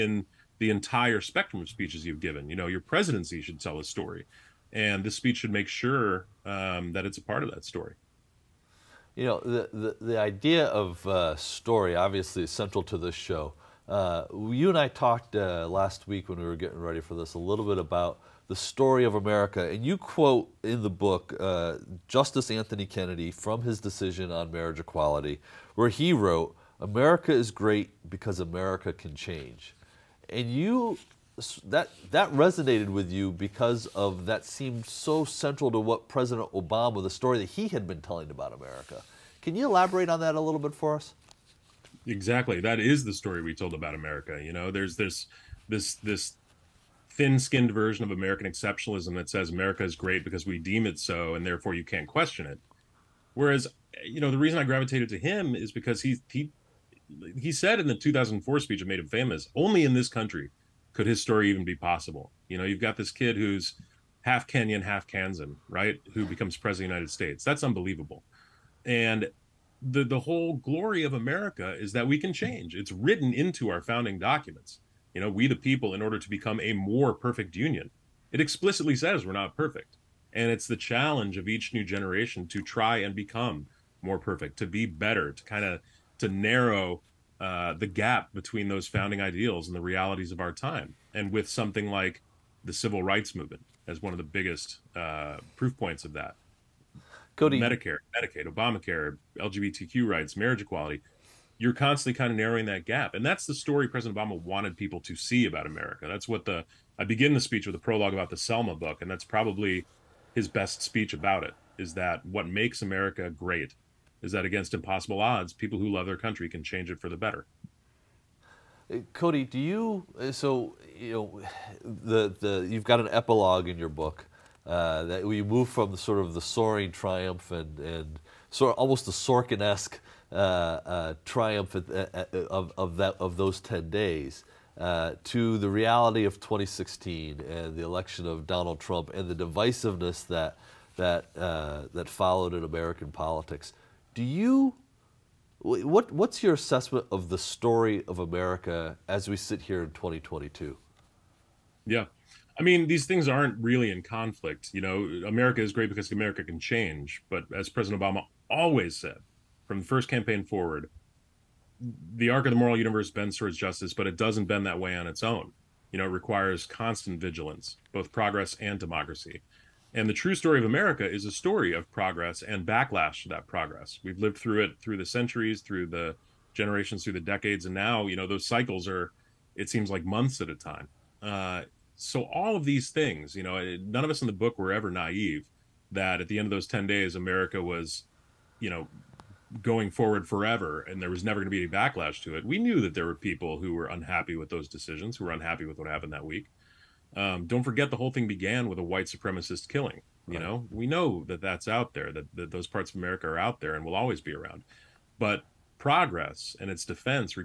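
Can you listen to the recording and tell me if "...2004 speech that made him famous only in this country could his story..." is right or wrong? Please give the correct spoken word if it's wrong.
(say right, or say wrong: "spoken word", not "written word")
right.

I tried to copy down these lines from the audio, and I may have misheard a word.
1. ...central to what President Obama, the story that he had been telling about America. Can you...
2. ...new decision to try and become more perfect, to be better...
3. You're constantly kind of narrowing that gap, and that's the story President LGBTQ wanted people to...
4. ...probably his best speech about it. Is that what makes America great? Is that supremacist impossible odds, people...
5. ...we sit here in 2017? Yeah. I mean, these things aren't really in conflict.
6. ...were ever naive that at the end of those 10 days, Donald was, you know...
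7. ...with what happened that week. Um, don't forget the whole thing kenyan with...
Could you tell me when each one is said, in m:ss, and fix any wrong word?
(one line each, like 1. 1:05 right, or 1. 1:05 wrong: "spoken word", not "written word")
1. 0:35 right
2. 1:21 wrong: "generation", not "decision"
3. 1:41 wrong: "Obama", not "LGBTQ"
4. 1:49 wrong: "against", not "supremacist"
5. 2:29 wrong: "2022", not "2017"
6. 3:04 wrong: "America", not "Donald"
7. 3:15 wrong: "began", not "kenyan".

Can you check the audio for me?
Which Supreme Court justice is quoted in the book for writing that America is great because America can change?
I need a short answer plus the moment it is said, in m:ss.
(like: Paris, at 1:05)
Anthony Kennedy, at 0:22.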